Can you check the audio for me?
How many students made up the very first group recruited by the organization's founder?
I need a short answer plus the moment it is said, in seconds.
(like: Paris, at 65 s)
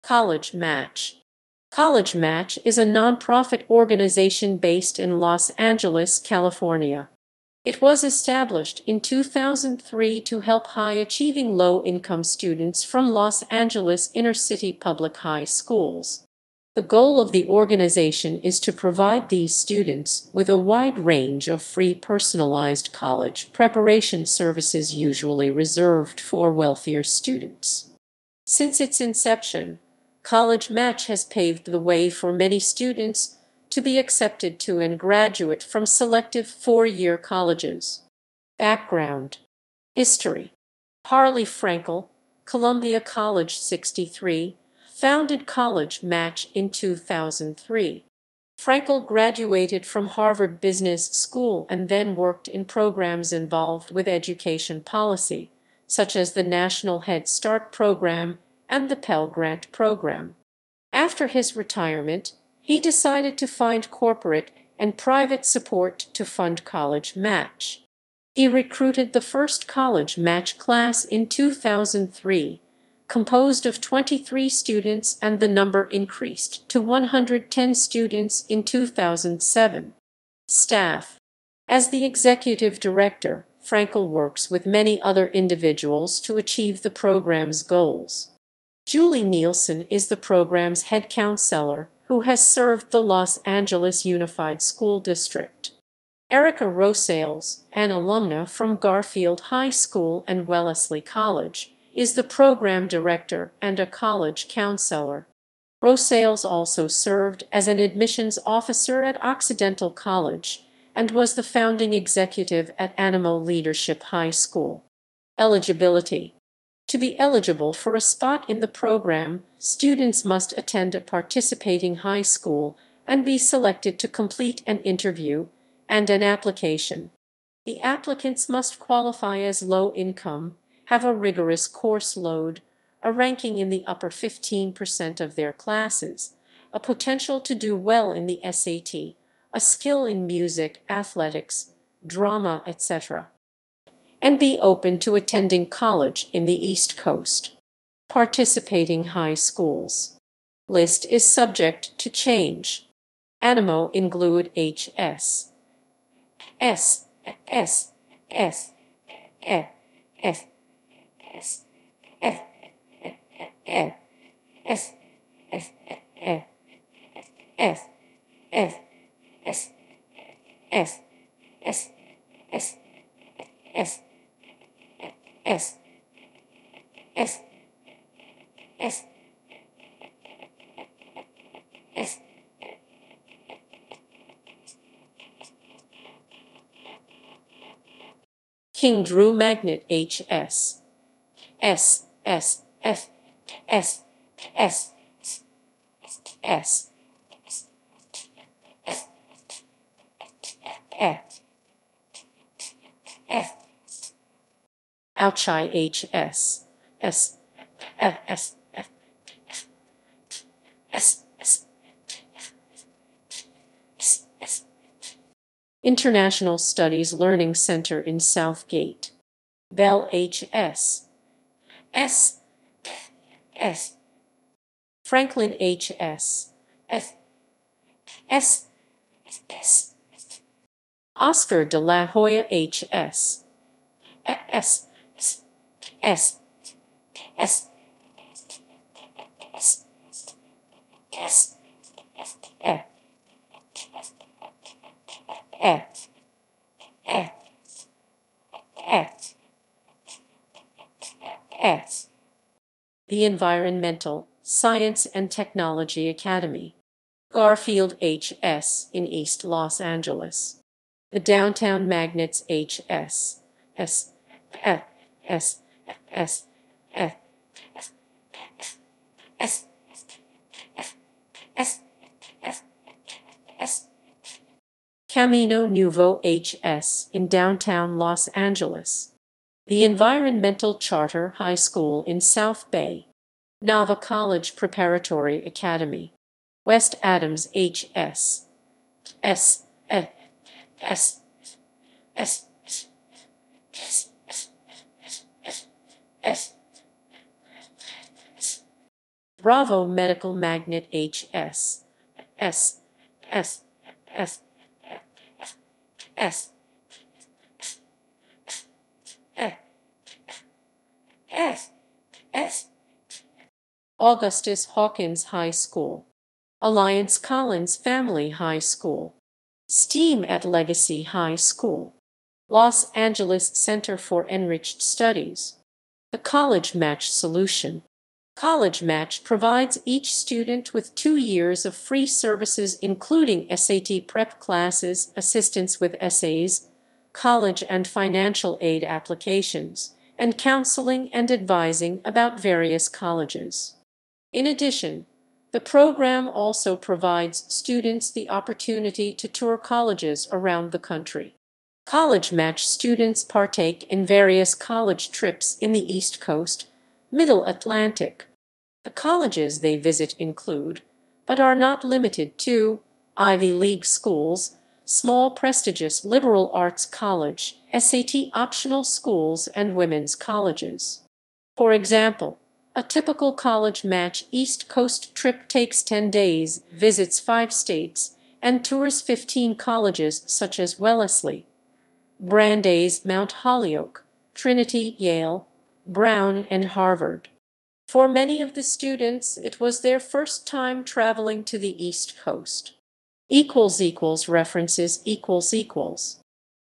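23, at 73 s.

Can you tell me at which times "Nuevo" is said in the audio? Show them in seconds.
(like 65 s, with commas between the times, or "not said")
275 s.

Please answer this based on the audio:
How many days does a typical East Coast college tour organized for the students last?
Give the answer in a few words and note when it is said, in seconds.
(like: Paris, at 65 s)
10, at 375 s.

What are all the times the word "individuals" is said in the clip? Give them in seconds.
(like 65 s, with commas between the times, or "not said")
85 s.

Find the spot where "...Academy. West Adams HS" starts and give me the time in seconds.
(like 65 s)
285 s.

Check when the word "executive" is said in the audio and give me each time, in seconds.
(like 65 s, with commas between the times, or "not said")
82 s, 111 s.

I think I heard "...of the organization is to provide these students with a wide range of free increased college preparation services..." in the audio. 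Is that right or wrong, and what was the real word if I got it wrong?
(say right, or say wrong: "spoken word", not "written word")
wrong: "personalized", not "increased".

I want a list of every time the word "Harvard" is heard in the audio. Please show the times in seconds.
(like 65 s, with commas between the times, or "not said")
50 s, 386 s.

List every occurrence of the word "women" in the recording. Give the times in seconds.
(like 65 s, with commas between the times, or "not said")
369 s.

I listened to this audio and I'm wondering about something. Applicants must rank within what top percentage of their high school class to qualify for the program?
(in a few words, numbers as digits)
15%.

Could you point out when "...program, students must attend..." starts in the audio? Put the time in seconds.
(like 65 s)
118 s.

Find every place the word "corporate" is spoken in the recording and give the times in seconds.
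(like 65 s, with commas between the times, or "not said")
63 s.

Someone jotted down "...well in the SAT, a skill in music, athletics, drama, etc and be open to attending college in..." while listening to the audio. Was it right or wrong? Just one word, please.
right.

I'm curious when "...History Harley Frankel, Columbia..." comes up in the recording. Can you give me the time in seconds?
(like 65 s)
39 s.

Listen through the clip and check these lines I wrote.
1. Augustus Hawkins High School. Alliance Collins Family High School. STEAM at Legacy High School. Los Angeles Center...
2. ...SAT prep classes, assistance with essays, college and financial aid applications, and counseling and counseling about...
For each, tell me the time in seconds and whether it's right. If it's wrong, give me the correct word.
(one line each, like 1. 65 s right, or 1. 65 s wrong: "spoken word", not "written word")
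1. 313 s right
2. 333 s wrong: "advising", not "counseling".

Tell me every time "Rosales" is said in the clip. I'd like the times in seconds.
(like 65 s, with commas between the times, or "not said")
96 s, 105 s.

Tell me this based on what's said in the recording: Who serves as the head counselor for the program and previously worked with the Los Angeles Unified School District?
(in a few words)
Julie Nielsen.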